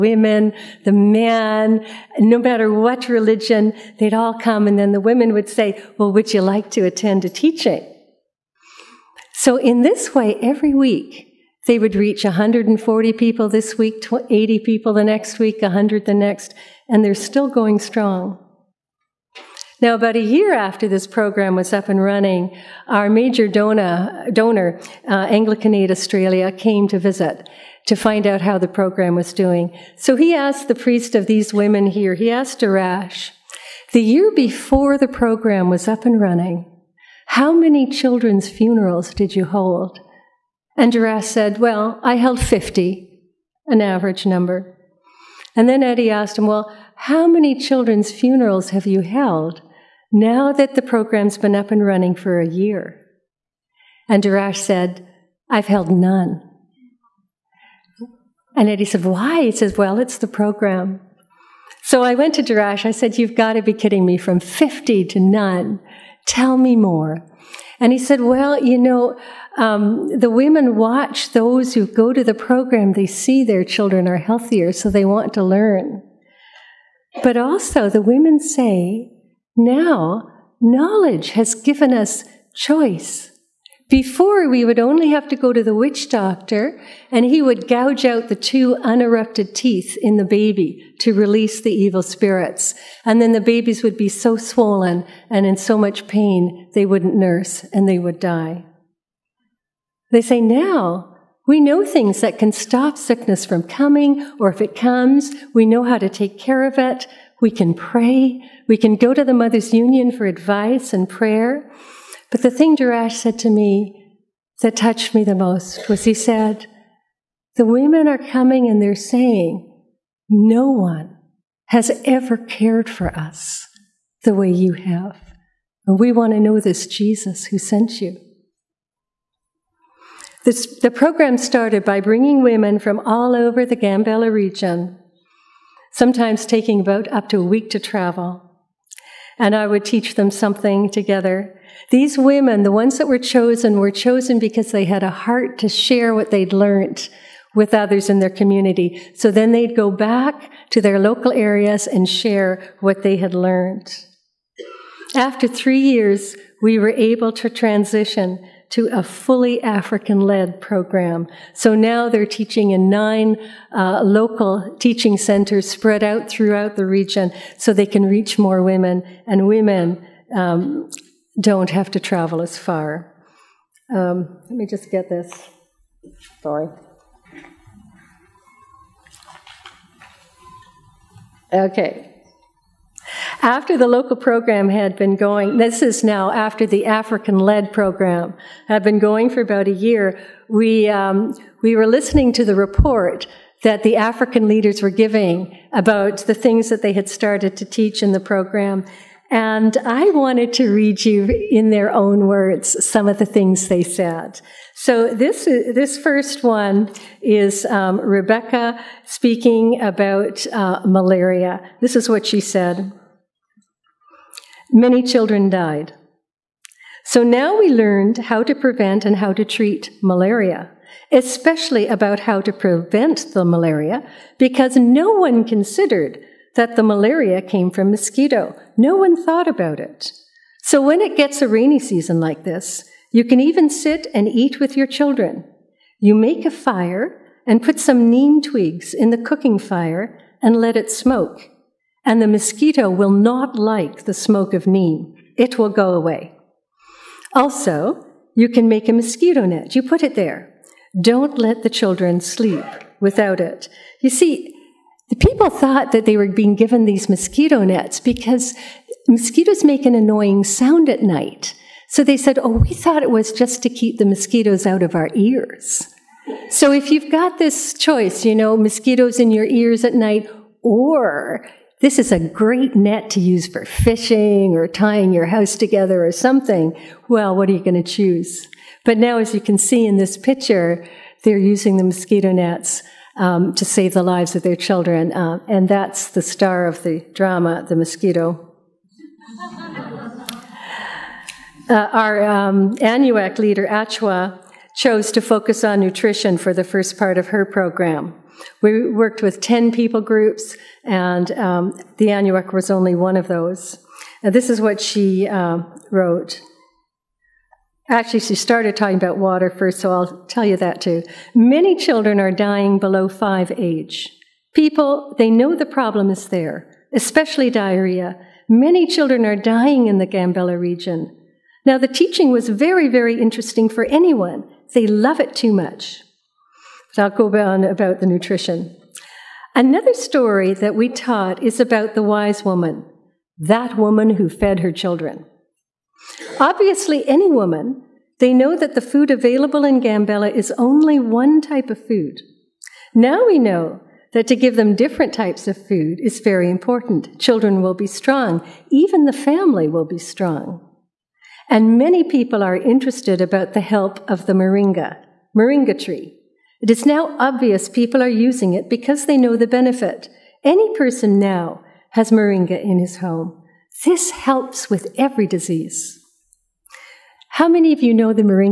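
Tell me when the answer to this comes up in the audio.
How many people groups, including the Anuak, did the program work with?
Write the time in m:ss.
4:59.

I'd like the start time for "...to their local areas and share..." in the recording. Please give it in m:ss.
2:30.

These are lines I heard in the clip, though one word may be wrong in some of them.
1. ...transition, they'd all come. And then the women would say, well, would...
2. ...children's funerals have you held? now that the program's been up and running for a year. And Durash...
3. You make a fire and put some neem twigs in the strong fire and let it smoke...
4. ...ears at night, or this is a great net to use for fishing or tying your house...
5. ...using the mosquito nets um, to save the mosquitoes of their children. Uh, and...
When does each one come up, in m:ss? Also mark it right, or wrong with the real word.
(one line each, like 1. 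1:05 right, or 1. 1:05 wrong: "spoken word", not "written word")
1. 0:03 wrong: "religion", not "transition"
2. 0:47 right
3. 3:56 wrong: "cooking", not "strong"
4. 4:29 right
5. 4:41 wrong: "lives", not "mosquitoes".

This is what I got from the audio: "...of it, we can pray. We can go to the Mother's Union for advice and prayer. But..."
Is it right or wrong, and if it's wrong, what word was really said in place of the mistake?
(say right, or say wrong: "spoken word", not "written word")
right.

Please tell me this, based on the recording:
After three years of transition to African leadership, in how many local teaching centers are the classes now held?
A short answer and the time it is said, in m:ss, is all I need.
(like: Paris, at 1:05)
9, at 2:42.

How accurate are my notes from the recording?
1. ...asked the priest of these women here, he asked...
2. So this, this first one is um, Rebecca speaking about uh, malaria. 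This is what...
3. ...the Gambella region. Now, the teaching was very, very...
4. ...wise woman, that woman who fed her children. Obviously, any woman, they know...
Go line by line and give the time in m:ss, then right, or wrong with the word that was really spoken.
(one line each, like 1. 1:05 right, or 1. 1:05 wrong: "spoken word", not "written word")
1. 0:30 right
2. 3:24 right
3. 5:19 right
4. 5:32 right.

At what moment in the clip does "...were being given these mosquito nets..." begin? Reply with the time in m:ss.
4:16.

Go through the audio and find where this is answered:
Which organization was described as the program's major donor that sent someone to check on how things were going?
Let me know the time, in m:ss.
0:25.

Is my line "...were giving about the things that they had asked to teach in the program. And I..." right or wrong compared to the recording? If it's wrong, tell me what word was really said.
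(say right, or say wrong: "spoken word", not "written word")
wrong: "started", not "asked".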